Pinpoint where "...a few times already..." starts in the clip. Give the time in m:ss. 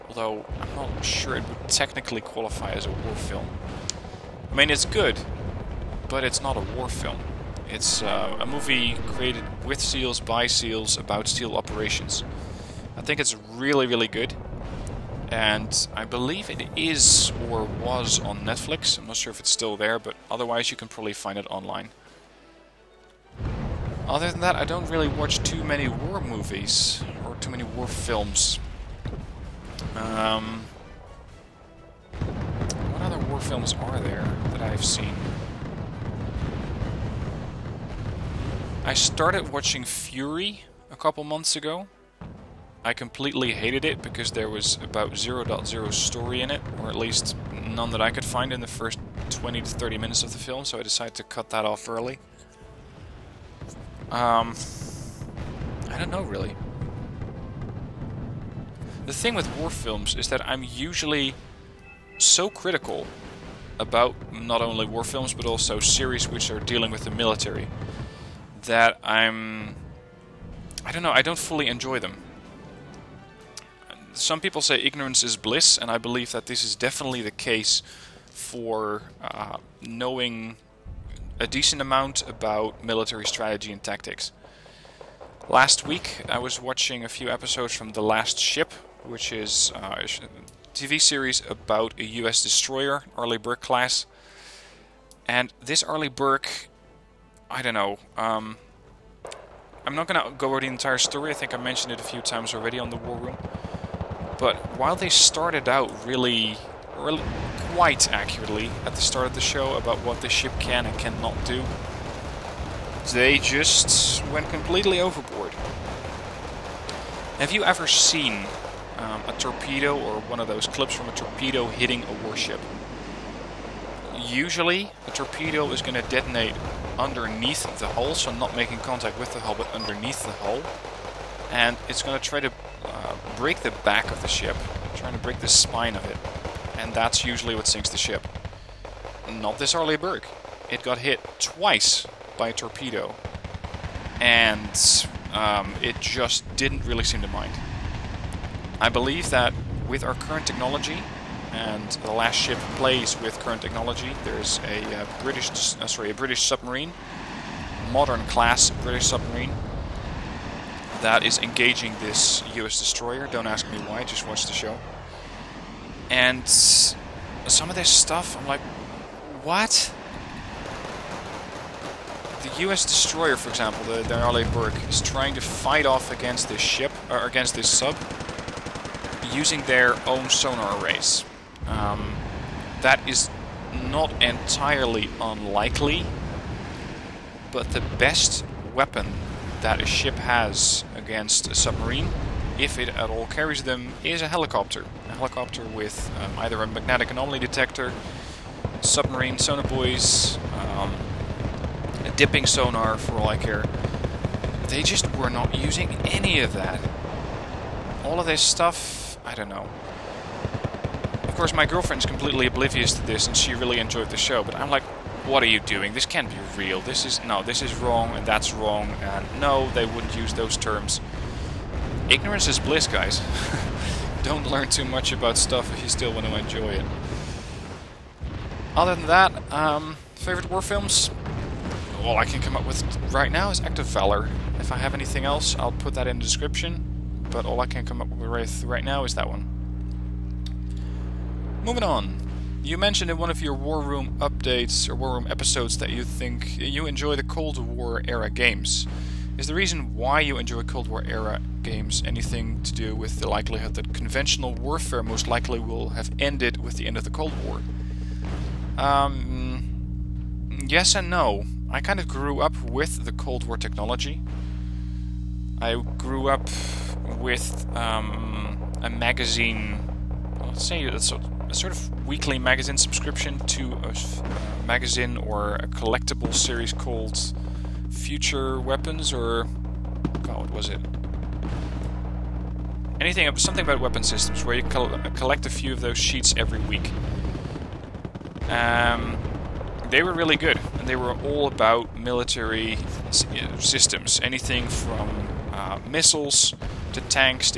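1:42.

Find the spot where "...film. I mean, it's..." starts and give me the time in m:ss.
0:03.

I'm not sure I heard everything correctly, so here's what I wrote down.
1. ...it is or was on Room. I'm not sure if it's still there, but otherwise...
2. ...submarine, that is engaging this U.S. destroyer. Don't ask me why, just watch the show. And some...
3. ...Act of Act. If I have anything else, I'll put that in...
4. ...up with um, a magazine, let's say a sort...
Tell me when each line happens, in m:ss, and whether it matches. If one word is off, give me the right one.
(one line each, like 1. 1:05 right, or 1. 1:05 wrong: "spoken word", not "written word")
1. 0:16 wrong: "Netflix", not "Room"
2. 2:39 right
3. 3:53 wrong: "Valor", not "Act"
4. 4:26 right.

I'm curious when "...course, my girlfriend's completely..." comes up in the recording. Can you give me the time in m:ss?
3:31.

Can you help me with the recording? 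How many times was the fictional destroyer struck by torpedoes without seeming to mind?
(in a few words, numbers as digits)
2.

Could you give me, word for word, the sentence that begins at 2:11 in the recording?
And it's going to try to uh, break the back of the ship, trying to break the spine of it.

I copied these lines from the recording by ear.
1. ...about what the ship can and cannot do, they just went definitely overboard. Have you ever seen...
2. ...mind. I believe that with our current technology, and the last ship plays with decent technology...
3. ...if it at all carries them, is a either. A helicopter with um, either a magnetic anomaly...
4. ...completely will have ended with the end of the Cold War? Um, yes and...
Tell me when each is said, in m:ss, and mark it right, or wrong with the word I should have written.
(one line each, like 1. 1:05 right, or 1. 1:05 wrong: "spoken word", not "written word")
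1. 1:49 wrong: "completely", not "definitely"
2. 2:27 wrong: "current", not "decent"
3. 3:12 wrong: "helicopter", not "either"
4. 4:15 wrong: "likely", not "completely".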